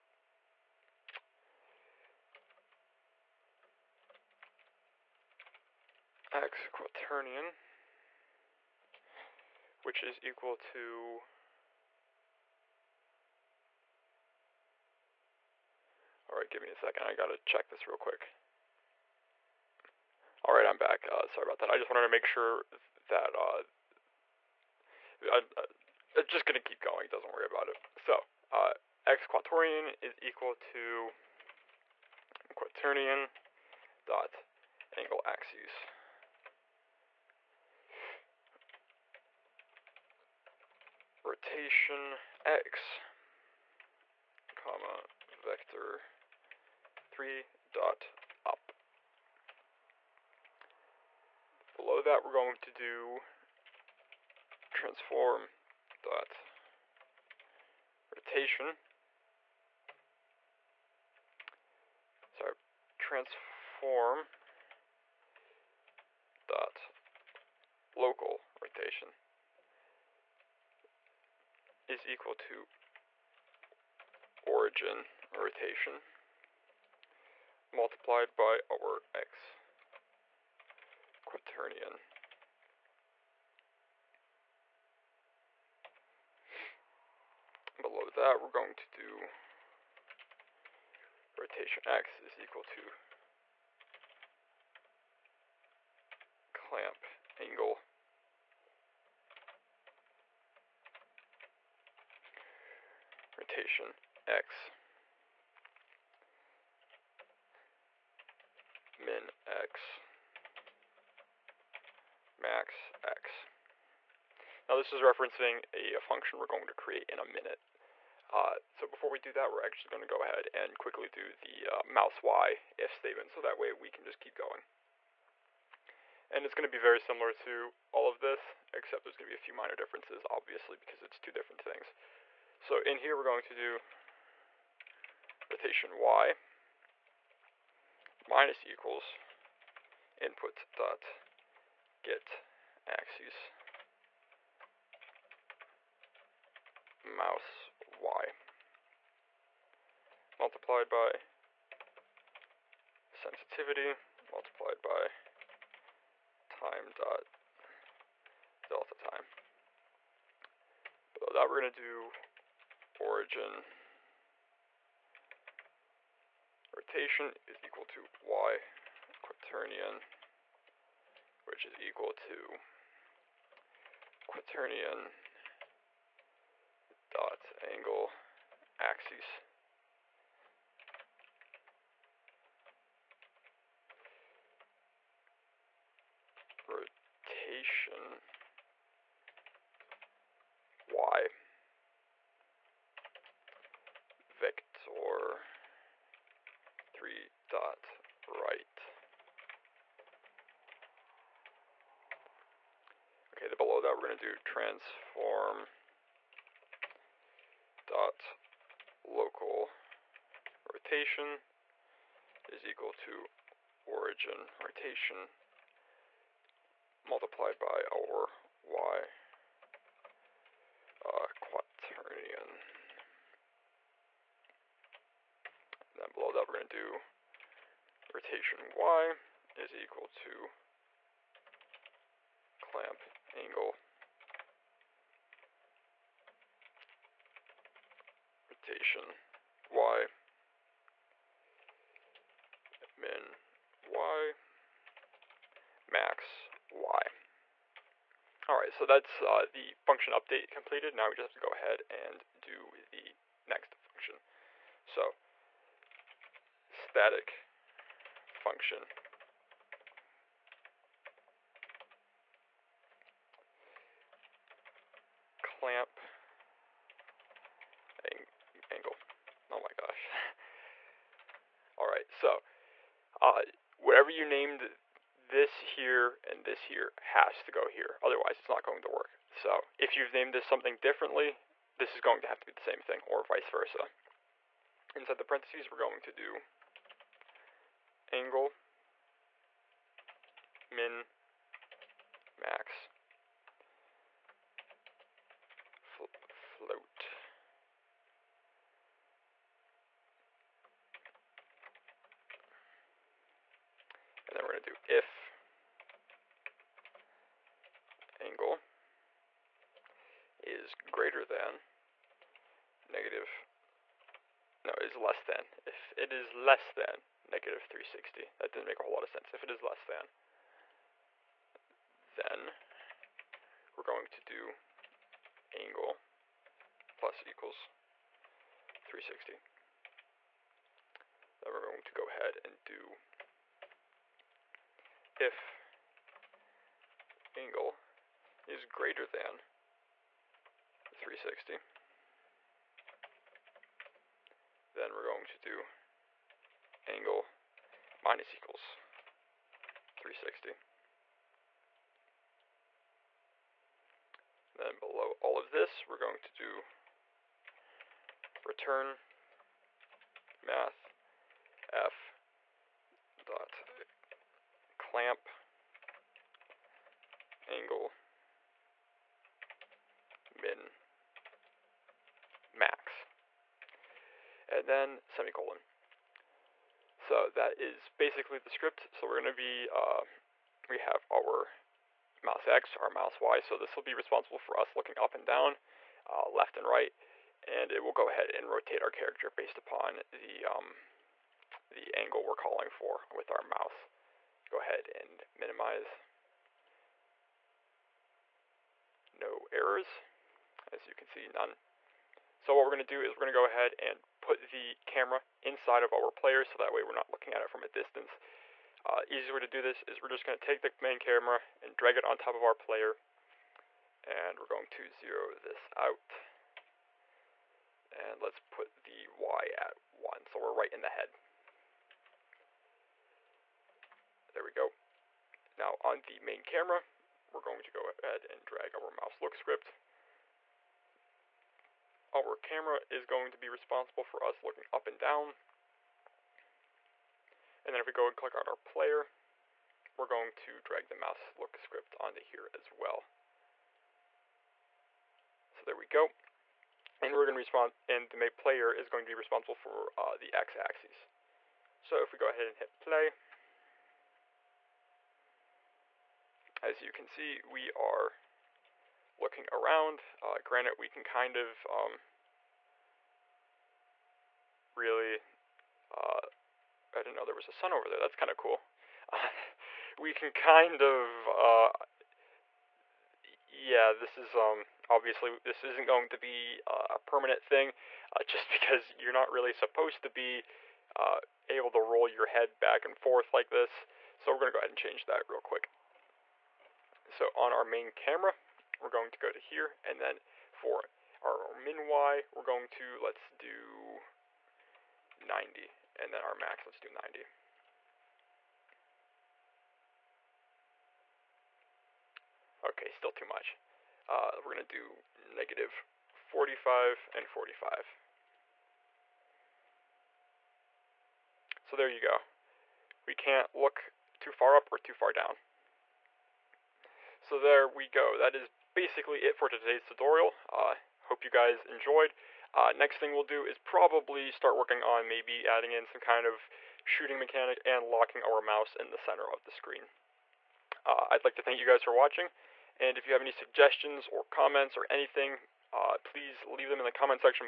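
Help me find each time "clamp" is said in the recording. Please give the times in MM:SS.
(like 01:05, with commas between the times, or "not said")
01:36, 03:52, 04:25, 06:04.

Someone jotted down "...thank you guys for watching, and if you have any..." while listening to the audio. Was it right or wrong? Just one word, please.
right.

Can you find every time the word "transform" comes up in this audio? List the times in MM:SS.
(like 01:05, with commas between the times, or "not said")
00:54, 01:02, 03:24.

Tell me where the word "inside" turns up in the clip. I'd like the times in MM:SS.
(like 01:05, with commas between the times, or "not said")
04:44, 06:45.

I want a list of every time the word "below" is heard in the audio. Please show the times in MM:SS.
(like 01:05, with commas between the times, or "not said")
00:51, 01:27, 03:23, 03:46, 05:54.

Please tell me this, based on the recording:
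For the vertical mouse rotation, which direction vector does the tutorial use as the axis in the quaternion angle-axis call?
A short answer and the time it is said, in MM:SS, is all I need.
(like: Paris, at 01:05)
Vector3.right, at 03:16.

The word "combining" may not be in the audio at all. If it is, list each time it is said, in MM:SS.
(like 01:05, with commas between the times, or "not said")
not said.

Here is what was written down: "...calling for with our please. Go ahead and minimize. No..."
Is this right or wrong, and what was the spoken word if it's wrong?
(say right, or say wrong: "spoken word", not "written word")
wrong: "mouse", not "please".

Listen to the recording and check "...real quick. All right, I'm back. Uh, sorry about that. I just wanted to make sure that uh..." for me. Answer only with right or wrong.
right.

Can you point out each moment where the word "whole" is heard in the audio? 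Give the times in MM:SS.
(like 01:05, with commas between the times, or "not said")
05:18.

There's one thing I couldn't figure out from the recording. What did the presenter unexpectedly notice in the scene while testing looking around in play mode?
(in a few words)
a sun.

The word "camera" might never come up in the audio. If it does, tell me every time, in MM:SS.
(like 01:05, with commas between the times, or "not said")
06:44, 06:50, 07:06, 07:12, 08:07.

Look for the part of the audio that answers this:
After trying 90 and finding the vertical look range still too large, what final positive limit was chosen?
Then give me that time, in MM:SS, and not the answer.
08:26.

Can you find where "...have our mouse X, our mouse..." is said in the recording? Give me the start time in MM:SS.
06:20.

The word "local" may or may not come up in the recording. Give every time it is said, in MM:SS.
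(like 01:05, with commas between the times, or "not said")
01:07, 03:29.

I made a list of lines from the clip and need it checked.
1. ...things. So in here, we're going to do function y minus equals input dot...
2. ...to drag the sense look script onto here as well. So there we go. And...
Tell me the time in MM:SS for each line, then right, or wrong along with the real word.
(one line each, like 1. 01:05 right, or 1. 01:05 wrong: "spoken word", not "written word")
1. 02:11 wrong: "rotation", not "function"
2. 07:20 wrong: "mouse", not "sense".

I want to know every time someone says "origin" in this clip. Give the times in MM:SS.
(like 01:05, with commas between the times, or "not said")
01:14, 02:42, 03:33.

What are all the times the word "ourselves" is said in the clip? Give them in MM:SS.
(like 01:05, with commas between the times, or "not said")
not said.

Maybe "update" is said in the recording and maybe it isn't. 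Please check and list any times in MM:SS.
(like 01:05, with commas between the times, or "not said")
04:10.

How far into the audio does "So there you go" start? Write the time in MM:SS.
08:31.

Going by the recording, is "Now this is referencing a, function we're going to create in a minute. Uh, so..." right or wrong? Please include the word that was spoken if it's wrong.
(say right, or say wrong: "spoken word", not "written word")
right.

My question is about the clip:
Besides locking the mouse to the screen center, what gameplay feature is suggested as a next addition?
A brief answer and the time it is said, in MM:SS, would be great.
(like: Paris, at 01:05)
shooting mechanic, at 08:46.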